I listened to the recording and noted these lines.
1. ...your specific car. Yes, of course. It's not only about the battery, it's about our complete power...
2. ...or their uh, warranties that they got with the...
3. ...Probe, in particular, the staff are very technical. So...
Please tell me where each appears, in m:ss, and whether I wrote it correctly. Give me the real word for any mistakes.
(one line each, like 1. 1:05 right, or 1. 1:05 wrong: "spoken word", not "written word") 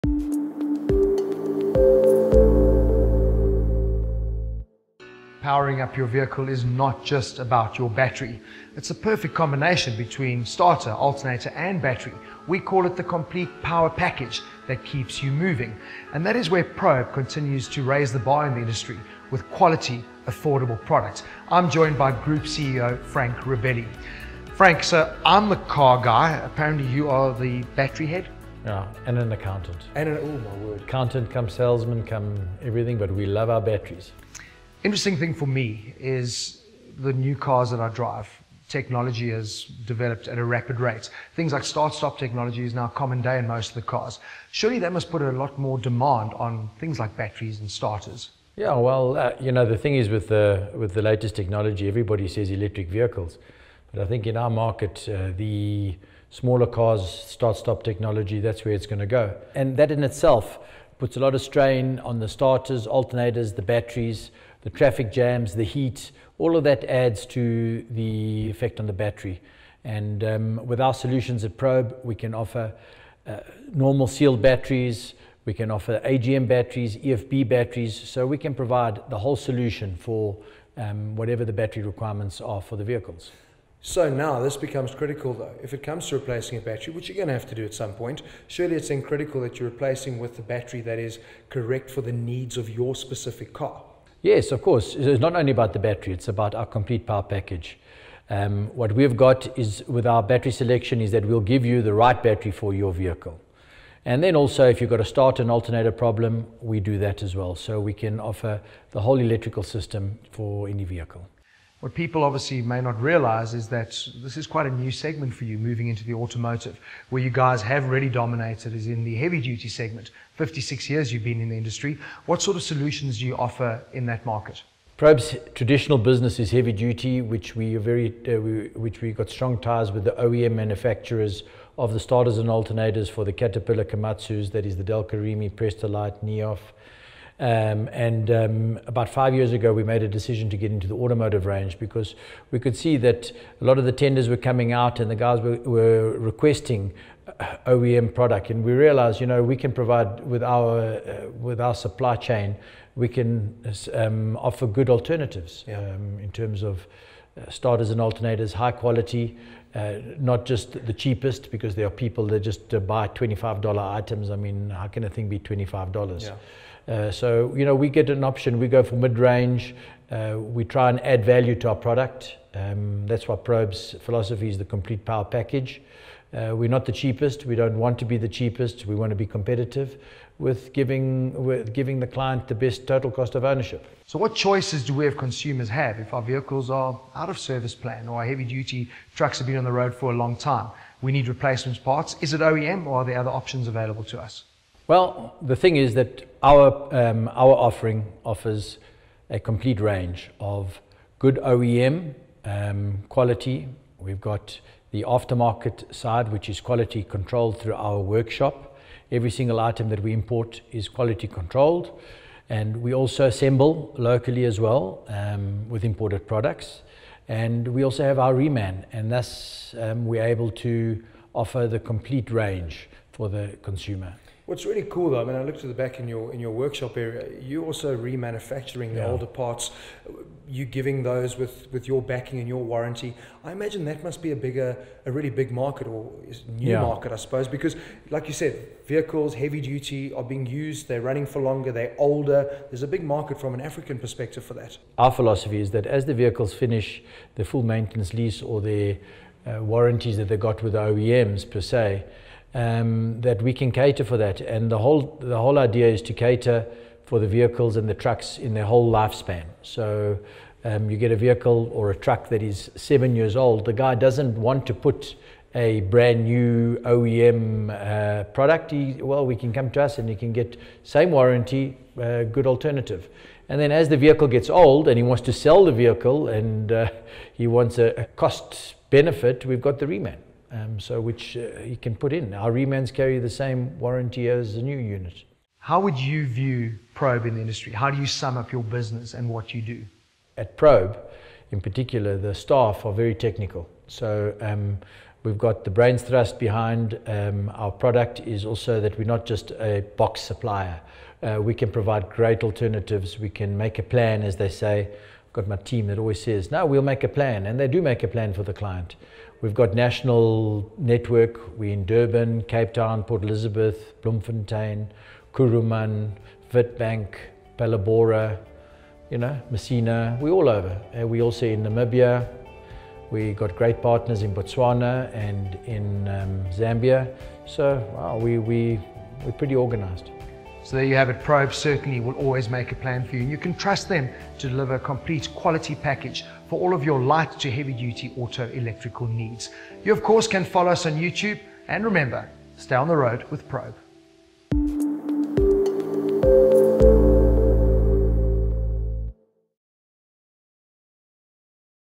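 1. 1:32 right
2. 4:08 right
3. 4:50 right.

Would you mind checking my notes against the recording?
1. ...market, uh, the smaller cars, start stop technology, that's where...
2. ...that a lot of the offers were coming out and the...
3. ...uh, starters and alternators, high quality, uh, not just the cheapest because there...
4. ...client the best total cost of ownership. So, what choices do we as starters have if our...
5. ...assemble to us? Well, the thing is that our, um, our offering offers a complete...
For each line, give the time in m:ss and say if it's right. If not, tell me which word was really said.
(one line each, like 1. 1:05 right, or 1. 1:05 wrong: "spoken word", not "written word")
1. 0:54 right
2. 2:22 wrong: "tenders", not "offers"
3. 2:37 right
4. 3:02 wrong: "consumers", not "starters"
5. 3:13 wrong: "available", not "assemble".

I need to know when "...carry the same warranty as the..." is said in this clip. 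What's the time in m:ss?
4:42.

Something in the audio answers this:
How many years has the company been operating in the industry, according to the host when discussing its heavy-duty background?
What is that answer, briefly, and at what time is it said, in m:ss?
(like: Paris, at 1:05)
56, at 2:00.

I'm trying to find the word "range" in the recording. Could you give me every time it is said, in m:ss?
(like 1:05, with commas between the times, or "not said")
2:21, 2:49, 3:19, 3:42.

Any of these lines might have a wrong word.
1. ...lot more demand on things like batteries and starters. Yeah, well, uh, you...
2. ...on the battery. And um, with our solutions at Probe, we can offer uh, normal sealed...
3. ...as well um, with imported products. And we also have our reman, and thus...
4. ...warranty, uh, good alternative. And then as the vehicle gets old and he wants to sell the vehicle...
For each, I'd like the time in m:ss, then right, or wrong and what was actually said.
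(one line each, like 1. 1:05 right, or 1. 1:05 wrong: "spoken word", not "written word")
1. 0:45 right
2. 1:08 right
3. 3:34 right
4. 4:31 right.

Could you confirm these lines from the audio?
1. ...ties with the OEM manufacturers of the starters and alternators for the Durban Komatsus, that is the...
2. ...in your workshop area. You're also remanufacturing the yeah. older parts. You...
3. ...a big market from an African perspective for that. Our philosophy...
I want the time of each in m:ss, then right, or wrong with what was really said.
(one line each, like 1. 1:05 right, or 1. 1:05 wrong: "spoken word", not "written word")
1. 2:09 wrong: "Caterpillar", not "Durban"
2. 3:46 right
3. 4:02 right.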